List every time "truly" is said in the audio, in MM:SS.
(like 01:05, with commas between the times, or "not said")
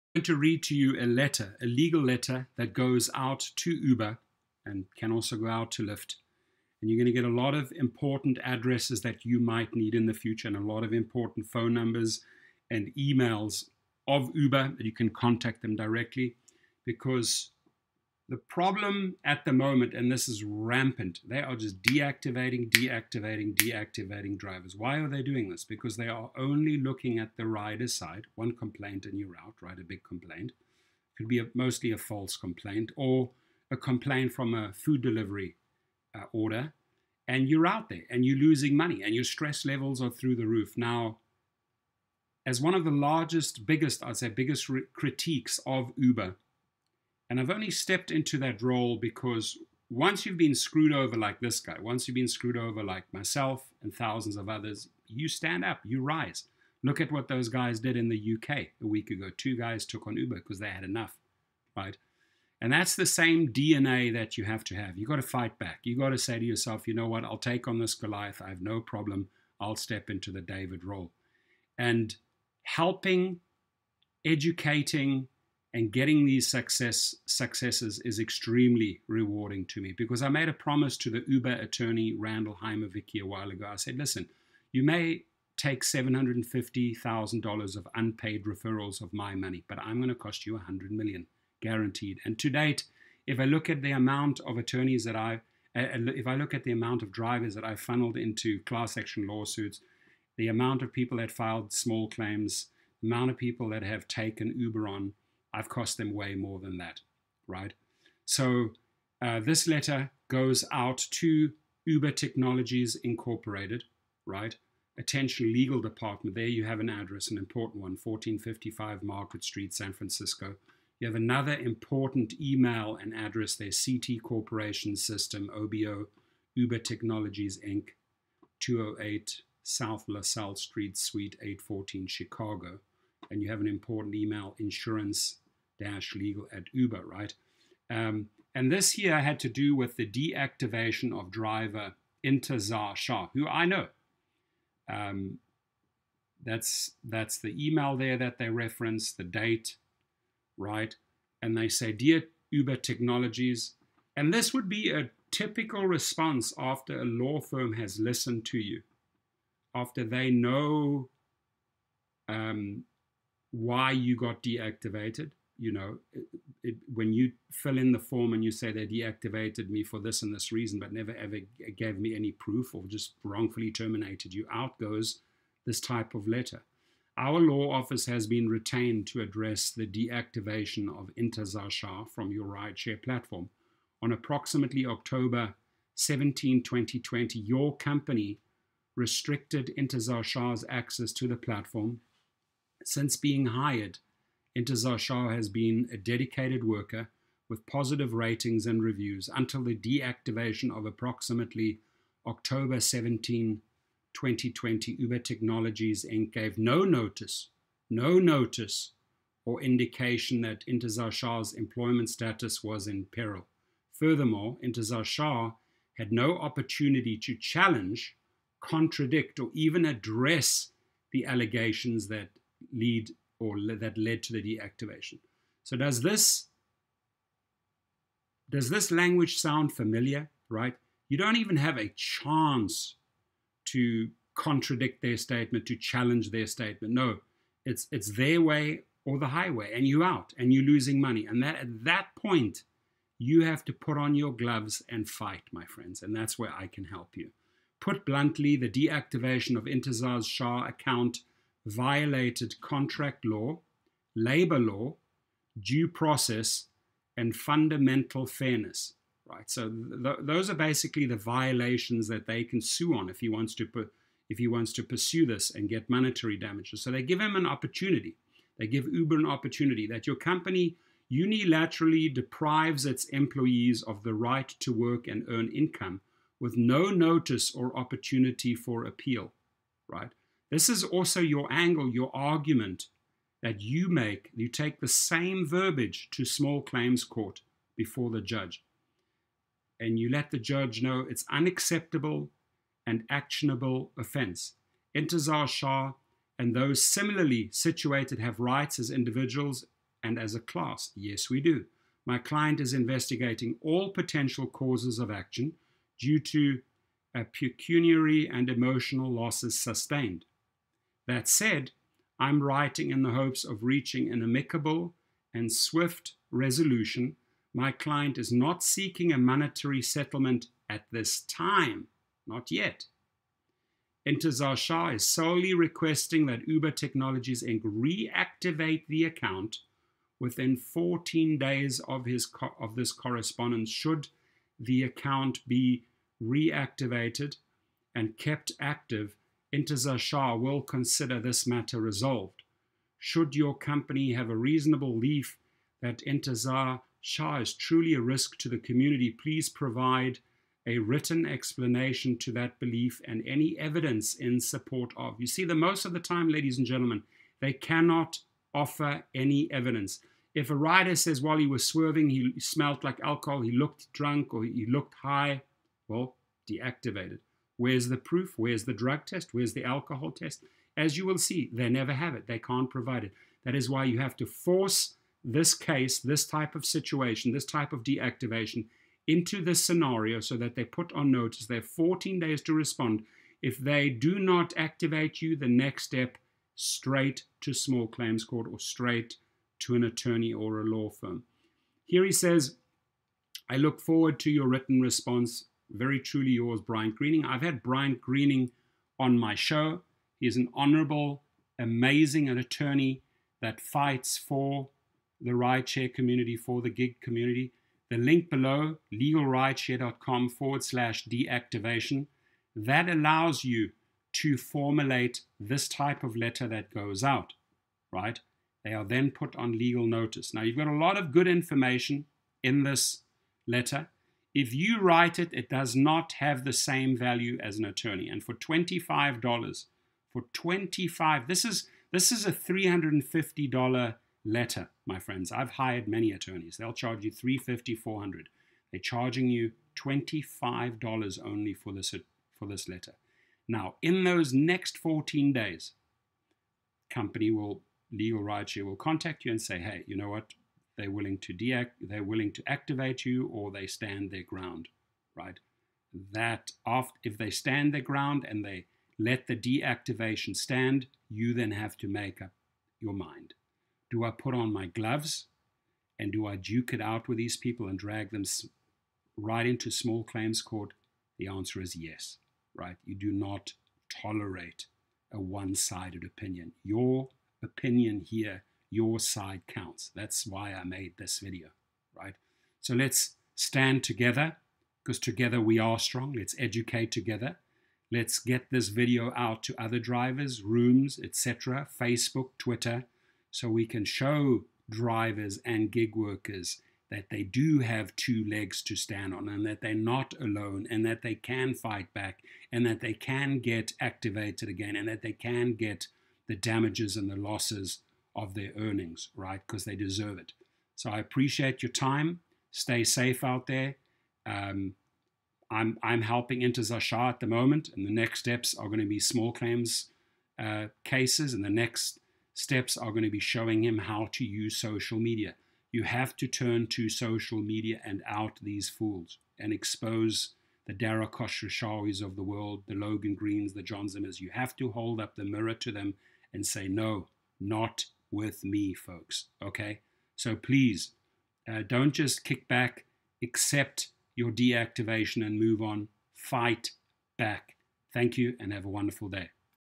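05:47, 06:35.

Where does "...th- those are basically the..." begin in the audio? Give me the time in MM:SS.
04:19.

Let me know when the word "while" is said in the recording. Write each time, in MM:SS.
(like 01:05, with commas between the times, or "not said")
01:23, 06:01.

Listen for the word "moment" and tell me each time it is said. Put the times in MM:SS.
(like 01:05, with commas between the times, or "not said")
00:19, 08:37.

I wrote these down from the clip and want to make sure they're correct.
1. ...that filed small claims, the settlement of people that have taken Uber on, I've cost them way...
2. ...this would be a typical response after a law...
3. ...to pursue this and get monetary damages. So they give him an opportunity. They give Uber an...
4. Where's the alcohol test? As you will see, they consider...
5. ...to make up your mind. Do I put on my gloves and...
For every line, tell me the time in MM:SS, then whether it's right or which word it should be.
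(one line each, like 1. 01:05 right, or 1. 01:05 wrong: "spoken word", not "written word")
1. 01:41 wrong: "amount", not "settlement"
2. 02:34 right
3. 04:24 right
4. 06:09 wrong: "never", not "consider"
5. 07:41 right.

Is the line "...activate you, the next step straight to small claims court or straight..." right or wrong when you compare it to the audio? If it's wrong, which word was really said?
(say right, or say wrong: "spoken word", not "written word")
right.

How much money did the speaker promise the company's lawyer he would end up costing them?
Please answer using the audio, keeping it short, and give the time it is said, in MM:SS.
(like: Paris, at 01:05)
100 million, at 01:30.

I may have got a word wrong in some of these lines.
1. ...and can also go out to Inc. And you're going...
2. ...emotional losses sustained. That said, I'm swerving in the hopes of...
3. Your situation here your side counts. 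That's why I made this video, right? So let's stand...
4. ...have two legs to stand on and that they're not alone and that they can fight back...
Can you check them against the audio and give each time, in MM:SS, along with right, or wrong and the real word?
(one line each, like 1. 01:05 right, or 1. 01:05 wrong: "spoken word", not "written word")
1. 00:04 wrong: "Lyft", not "Inc"
2. 05:08 wrong: "writing", not "swerving"
3. 07:56 wrong: "opinion", not "situation"
4. 08:17 right.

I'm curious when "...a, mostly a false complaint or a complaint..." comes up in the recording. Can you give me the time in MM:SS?
00:31.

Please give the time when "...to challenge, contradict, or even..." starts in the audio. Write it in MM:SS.
03:37.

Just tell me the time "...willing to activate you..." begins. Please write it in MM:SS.
07:32.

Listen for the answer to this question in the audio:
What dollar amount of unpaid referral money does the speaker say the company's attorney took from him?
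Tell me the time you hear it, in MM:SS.
01:25.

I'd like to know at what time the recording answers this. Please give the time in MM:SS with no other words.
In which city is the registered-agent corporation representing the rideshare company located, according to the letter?
02:12.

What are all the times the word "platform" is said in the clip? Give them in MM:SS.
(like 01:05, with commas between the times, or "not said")
03:03, 03:11.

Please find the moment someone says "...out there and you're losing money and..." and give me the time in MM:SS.
00:37.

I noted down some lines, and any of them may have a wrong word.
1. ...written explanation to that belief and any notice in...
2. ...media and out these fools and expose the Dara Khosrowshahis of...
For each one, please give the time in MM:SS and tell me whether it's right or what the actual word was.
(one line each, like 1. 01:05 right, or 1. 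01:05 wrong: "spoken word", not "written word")
1. 05:50 wrong: "evidence", not "notice"
2. 08:47 right.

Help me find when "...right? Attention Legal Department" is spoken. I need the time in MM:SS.
01:54.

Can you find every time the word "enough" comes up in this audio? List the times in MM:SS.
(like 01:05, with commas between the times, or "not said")
01:00.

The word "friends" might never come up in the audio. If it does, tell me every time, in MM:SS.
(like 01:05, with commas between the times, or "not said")
04:05, 07:14.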